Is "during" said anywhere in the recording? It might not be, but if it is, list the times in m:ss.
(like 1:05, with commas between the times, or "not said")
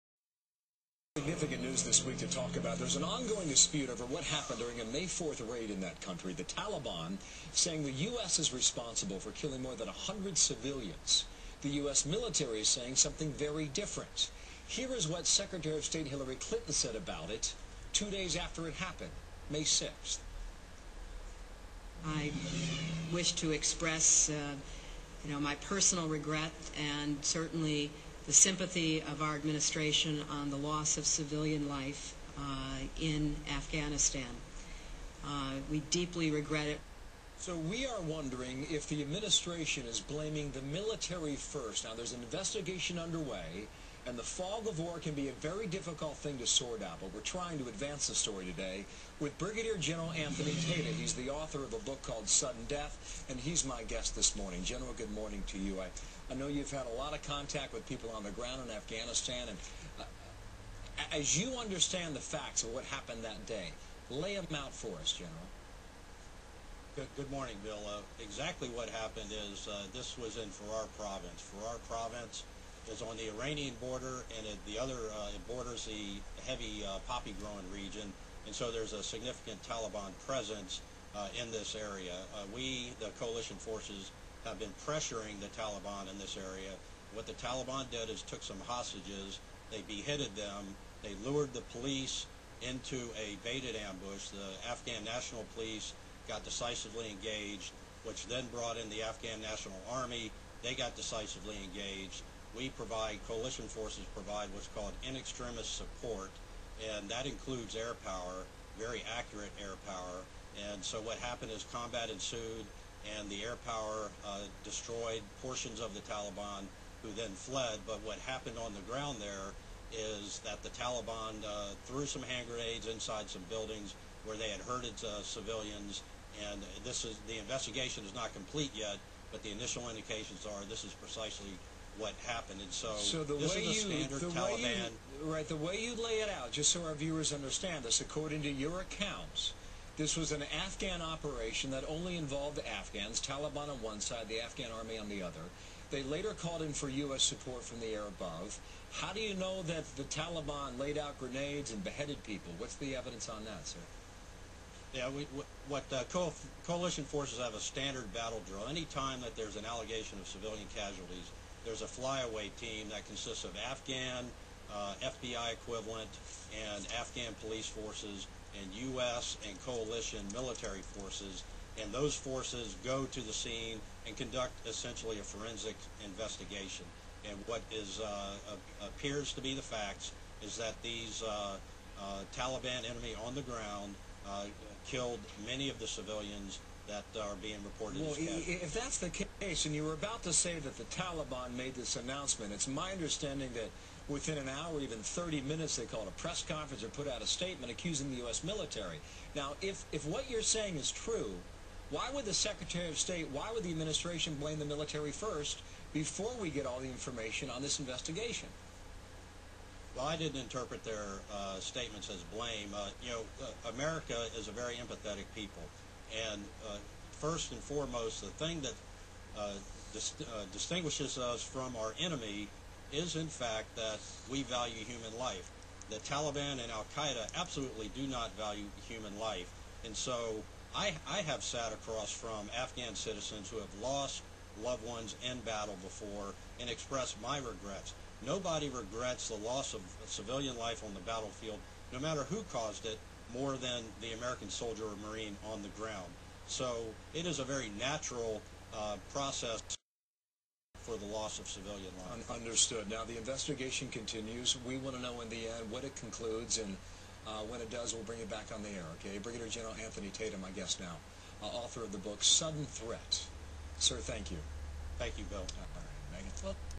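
0:04.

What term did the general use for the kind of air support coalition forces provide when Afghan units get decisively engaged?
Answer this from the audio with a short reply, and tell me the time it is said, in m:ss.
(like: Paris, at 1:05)
in extremis support, at 1:45.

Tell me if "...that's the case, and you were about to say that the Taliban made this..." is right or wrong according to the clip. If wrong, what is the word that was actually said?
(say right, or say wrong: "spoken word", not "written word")
right.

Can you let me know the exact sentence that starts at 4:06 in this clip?
So it is a very natural uh, process for the loss of civilian life.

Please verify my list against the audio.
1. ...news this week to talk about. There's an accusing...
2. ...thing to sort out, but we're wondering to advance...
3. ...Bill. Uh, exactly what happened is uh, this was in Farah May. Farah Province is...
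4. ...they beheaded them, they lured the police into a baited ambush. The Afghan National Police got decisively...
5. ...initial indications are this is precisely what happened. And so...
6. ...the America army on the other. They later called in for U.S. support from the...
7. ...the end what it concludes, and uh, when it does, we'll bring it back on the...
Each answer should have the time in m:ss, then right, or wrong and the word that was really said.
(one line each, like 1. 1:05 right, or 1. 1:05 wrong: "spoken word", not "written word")
1. 0:01 wrong: "ongoing", not "accusing"
2. 0:46 wrong: "trying", not "wondering"
3. 1:07 wrong: "Province", not "May"
4. 1:29 right
5. 2:09 right
6. 2:24 wrong: "Afghan", not "America"
7. 4:15 right.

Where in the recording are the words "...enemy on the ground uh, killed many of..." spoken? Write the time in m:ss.
3:02.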